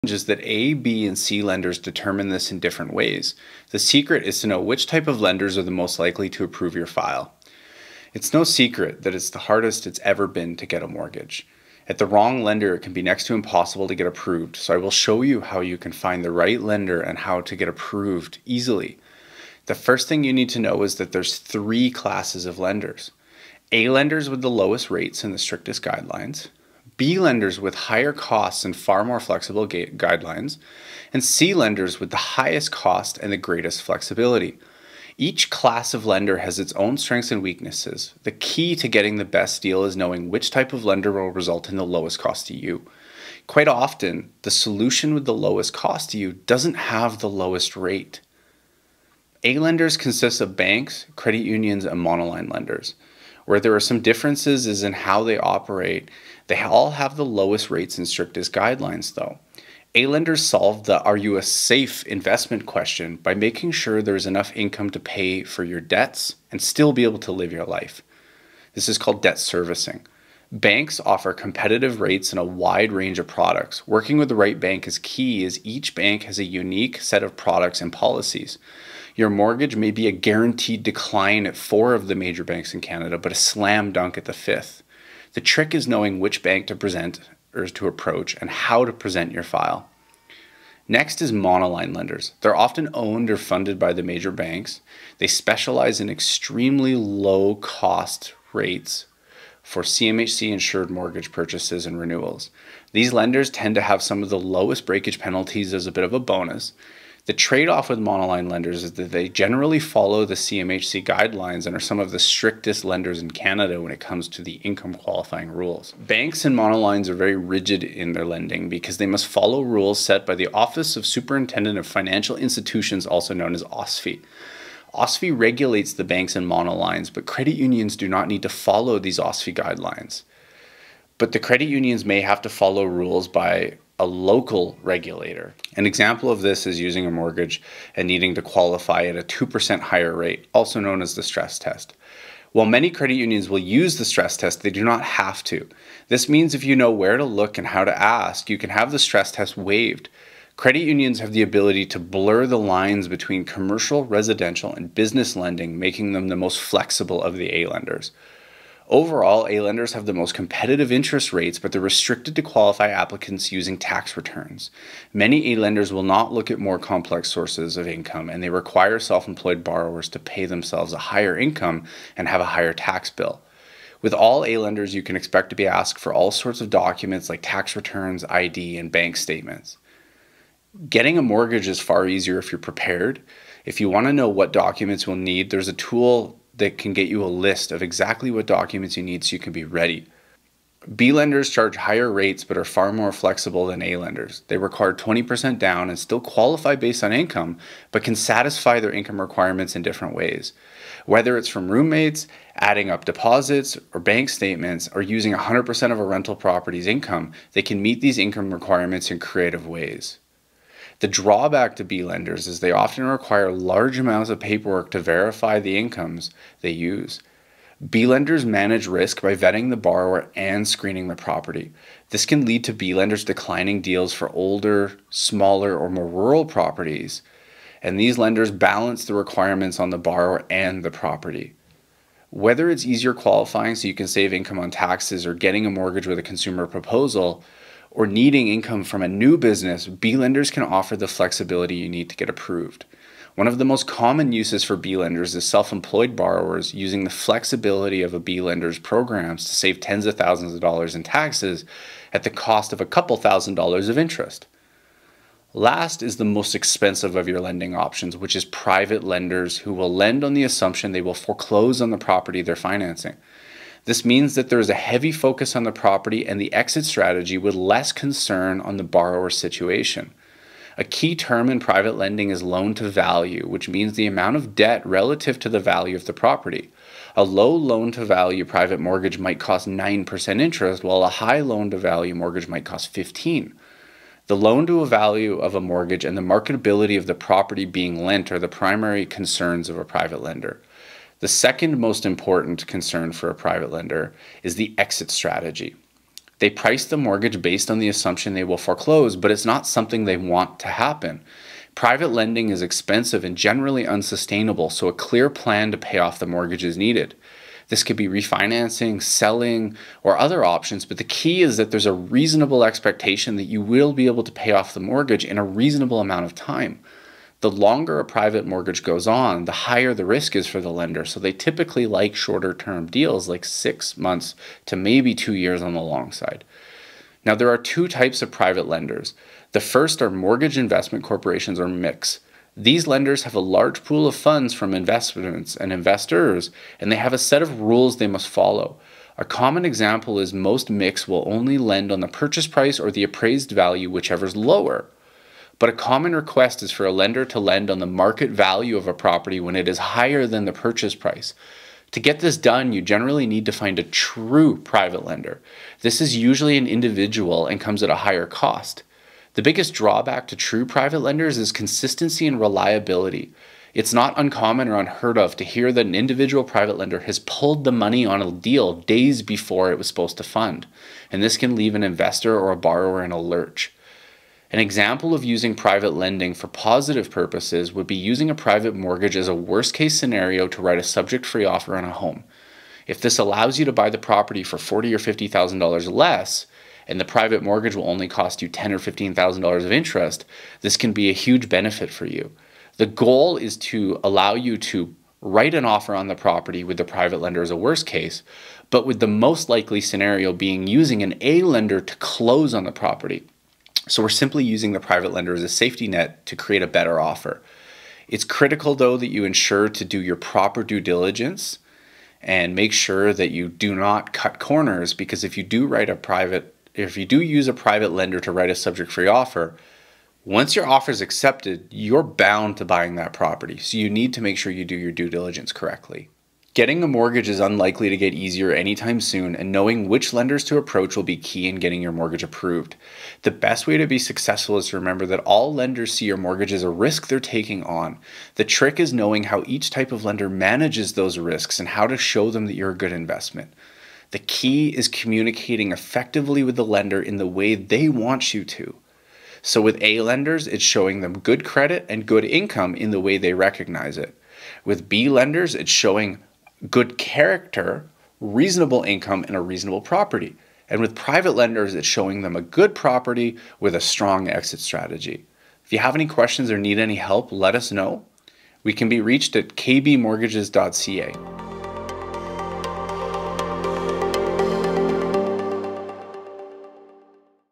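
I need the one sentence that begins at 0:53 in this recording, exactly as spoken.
Where there are some differences is in how they operate.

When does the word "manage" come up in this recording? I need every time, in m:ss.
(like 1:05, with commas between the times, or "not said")
3:38, 7:20.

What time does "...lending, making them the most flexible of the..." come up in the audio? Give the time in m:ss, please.
2:35.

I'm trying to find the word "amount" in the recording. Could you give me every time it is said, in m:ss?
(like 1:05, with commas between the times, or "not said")
3:33, 4:34, 5:15.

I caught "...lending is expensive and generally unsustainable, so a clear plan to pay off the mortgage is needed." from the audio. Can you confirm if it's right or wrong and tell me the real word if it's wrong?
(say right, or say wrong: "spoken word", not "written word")
right.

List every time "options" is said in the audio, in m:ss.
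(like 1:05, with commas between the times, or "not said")
4:17, 5:10.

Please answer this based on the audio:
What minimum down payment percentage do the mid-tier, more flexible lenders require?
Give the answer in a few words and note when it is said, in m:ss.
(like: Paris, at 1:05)
20%, at 3:14.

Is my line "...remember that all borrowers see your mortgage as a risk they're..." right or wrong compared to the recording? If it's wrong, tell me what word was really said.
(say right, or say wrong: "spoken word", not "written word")
wrong: "lenders", not "borrowers".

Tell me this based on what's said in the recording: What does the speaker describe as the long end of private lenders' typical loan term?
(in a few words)
two years.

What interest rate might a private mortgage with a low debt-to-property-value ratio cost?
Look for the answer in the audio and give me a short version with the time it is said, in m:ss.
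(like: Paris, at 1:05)
9%, at 4:39.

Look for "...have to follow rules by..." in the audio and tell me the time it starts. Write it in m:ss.
2:12.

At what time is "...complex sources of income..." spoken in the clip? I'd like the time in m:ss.
2:46.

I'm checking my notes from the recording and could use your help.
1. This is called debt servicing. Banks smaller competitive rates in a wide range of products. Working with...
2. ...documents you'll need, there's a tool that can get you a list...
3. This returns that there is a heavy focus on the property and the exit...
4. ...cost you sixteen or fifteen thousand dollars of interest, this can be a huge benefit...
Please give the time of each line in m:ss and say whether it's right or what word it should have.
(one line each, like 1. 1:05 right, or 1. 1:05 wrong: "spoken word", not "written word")
1. 1:08 wrong: "offer", not "smaller"
2. 3:04 right
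3. 4:23 wrong: "means", not "returns"
4. 6:28 wrong: "ten", not "sixteen".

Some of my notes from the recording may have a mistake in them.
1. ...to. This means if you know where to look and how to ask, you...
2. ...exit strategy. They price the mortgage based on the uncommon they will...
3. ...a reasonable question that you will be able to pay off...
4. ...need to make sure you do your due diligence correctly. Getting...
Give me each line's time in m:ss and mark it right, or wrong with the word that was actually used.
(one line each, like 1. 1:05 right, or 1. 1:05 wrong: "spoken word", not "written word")
1. 2:25 right
2. 4:54 wrong: "assumption", not "uncommon"
3. 5:11 wrong: "expectation", not "question"
4. 7:03 right.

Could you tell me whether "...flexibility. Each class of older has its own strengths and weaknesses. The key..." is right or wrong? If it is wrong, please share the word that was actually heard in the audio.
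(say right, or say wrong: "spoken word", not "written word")
wrong: "lender", not "older".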